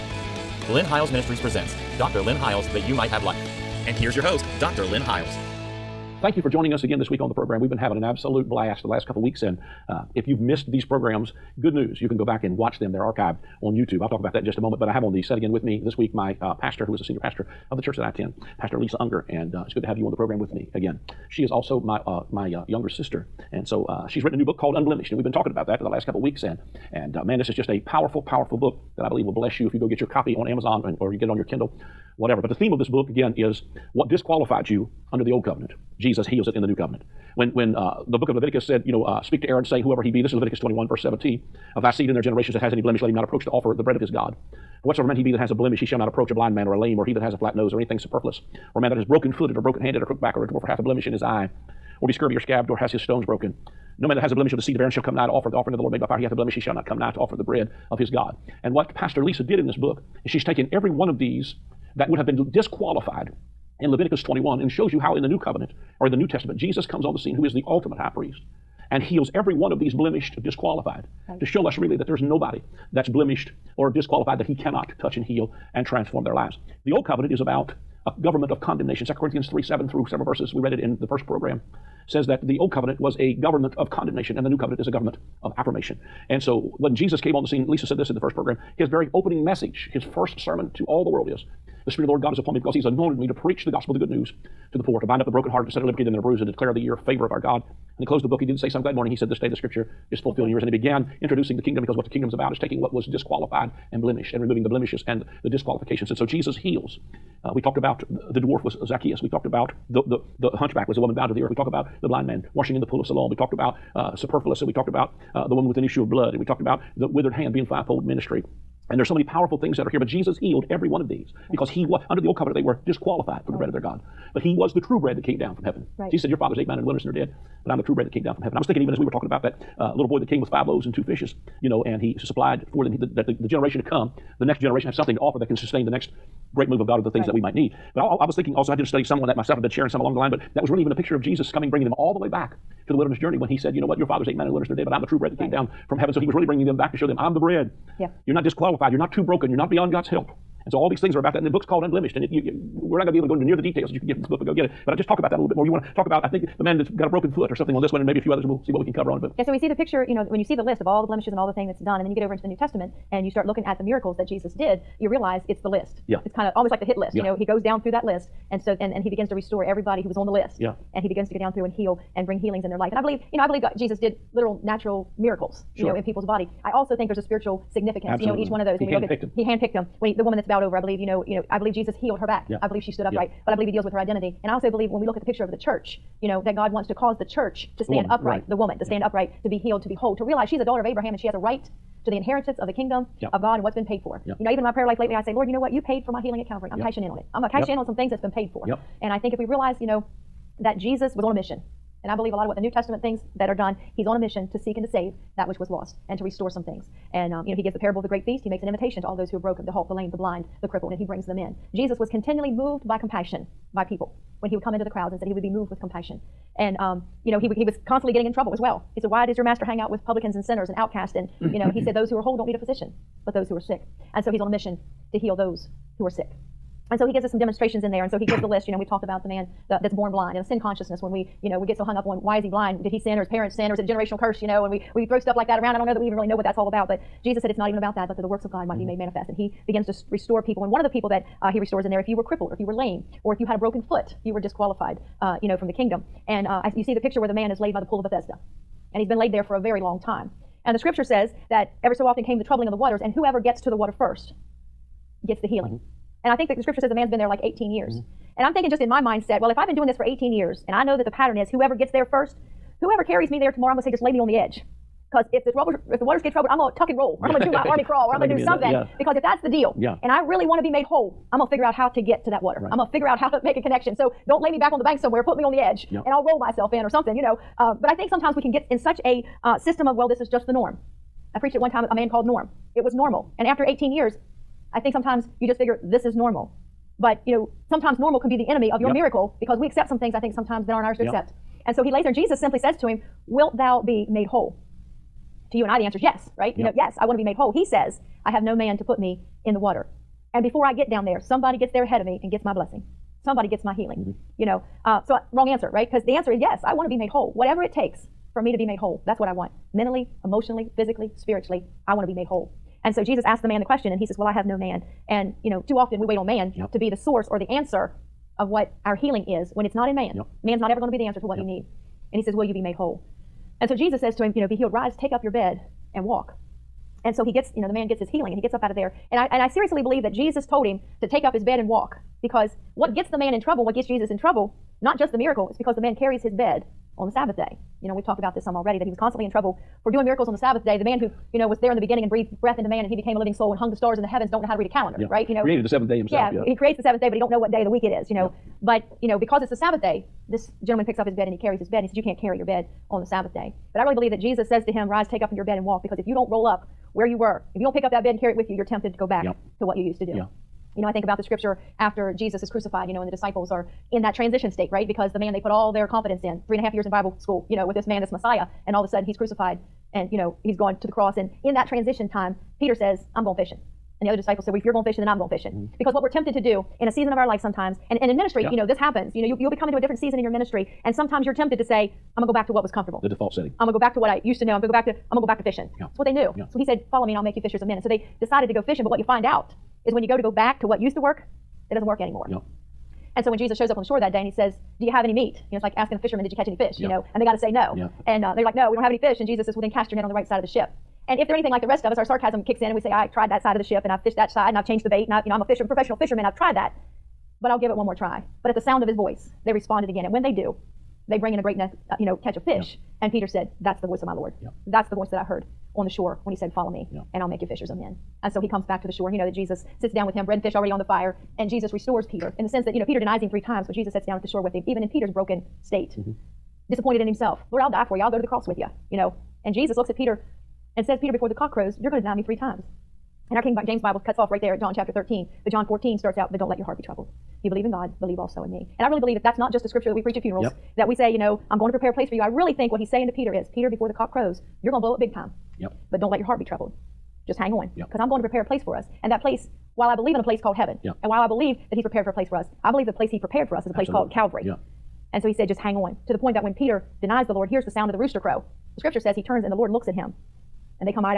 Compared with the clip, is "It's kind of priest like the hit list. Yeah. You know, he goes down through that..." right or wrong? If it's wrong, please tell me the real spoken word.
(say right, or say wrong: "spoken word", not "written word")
wrong: "almost", not "priest".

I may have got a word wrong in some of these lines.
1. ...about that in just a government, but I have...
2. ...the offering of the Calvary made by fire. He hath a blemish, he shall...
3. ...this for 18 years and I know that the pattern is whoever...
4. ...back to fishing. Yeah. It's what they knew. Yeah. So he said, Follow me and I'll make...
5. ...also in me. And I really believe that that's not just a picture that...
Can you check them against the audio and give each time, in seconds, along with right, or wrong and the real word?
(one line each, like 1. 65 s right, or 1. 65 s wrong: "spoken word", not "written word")
1. 14 s wrong: "moment", not "government"
2. 55 s wrong: "Lord", not "Calvary"
3. 259 s right
4. 385 s right
5. 438 s wrong: "scripture", not "picture".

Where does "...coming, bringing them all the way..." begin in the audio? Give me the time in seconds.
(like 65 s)
141 s.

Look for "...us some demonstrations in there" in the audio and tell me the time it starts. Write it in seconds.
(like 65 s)
227 s.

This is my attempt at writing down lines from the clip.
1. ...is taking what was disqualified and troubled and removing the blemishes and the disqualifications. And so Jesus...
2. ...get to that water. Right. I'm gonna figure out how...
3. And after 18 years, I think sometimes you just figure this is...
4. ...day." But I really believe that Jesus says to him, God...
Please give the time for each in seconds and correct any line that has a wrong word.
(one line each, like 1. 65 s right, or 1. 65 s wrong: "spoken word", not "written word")
1. 102 s wrong: "blemished", not "troubled"
2. 271 s right
3. 283 s right
4. 353 s wrong: "Rise", not "God".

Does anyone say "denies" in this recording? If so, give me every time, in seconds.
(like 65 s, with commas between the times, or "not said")
422 s, 457 s.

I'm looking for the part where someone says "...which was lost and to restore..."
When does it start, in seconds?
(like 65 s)
205 s.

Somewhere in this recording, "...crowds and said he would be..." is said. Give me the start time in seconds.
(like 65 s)
214 s.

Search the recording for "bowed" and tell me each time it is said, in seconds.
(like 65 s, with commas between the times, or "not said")
111 s, 180 s.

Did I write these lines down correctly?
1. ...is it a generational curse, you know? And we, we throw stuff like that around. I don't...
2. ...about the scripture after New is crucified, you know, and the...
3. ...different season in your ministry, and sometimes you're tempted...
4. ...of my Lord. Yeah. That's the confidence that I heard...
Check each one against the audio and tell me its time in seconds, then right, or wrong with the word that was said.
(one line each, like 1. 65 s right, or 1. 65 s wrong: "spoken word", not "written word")
1. 233 s right
2. 361 s wrong: "Jesus", not "New"
3. 379 s right
4. 414 s wrong: "voice", not "confidence".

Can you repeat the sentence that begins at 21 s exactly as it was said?
She is also my, uh, my uh, younger sister.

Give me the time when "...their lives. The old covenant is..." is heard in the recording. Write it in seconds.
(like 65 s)
76 s.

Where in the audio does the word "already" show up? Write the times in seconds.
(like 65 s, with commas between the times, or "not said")
338 s, 420 s.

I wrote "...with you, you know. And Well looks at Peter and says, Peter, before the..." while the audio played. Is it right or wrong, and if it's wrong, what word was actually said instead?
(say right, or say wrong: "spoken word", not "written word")
wrong: "Jesus", not "Well".